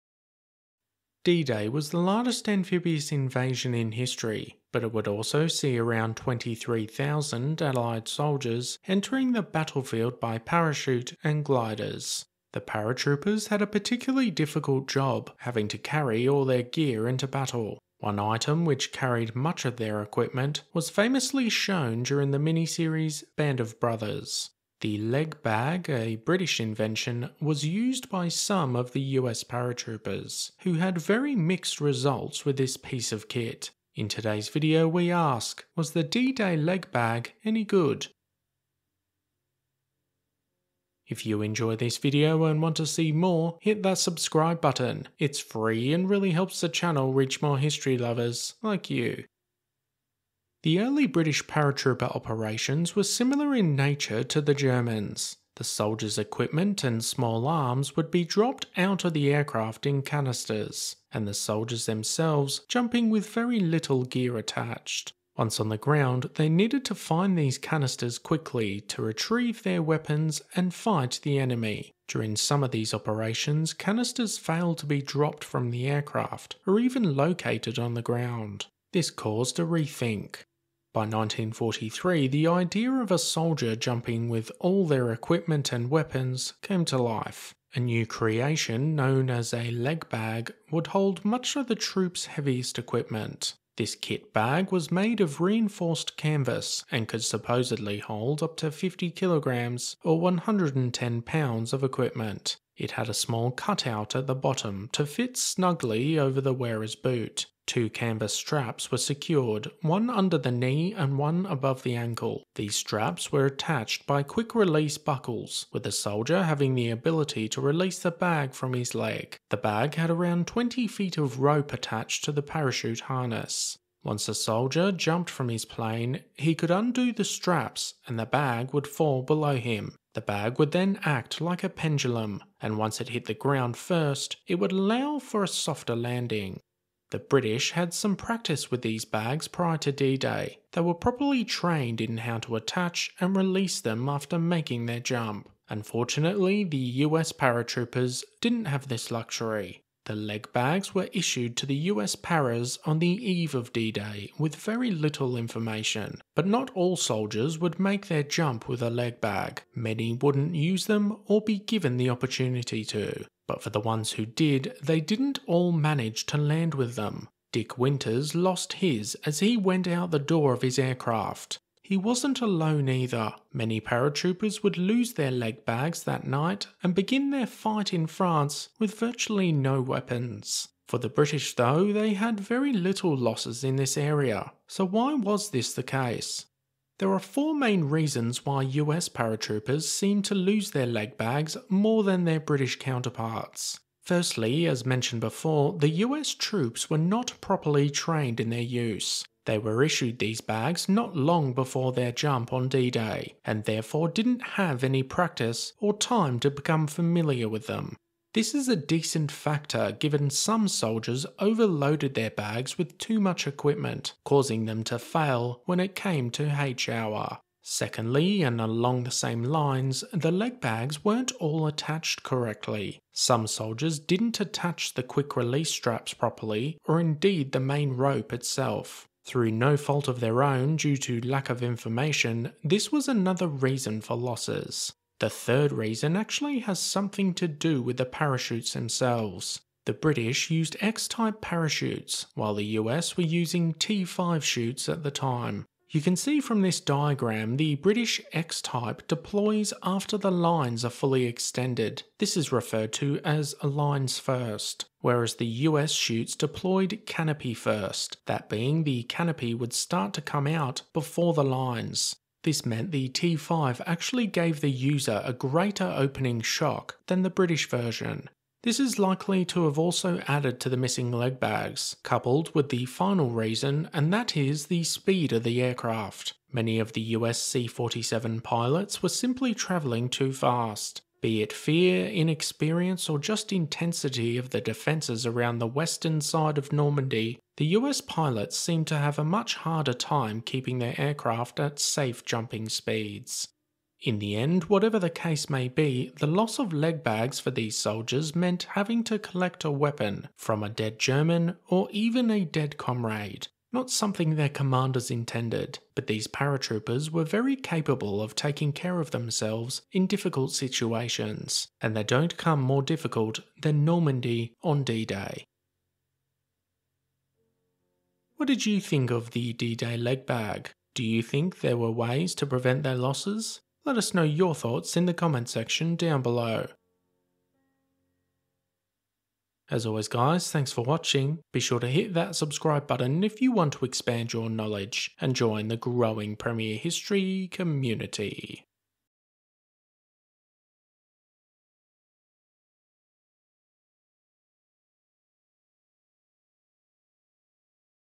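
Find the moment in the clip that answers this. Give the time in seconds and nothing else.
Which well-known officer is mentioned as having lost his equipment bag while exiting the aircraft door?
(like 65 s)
167 s.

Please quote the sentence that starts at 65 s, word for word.
Once on the ground, they needed to find these canisters quickly to retrieve their weapons and fight the enemy.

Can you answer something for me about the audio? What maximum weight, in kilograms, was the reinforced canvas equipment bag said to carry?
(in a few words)
50 kilograms.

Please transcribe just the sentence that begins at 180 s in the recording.
For the British, though, they had very little losses in this area.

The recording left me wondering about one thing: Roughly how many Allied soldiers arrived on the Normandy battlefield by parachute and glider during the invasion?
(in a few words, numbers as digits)
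23,000.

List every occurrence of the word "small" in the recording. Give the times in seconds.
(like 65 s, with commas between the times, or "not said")
57 s, 103 s.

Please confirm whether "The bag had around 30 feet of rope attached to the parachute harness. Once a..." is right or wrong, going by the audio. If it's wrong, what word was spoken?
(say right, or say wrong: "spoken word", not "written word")
wrong: "20", not "30".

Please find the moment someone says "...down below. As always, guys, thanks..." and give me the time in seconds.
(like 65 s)
325 s.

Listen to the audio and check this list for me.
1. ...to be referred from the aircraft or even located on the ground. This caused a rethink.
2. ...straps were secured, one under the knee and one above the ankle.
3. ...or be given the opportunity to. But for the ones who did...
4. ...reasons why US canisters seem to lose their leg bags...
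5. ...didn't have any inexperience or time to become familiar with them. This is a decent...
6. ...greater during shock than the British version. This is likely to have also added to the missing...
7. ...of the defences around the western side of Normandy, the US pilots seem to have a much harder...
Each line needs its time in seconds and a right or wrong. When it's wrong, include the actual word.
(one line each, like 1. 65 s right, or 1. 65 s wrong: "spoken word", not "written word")
1. 74 s wrong: "dropped", not "referred"
2. 108 s right
3. 161 s right
4. 187 s wrong: "paratroopers", not "canisters"
5. 204 s wrong: "practice", not "inexperience"
6. 265 s wrong: "opening", not "during"
7. 284 s right.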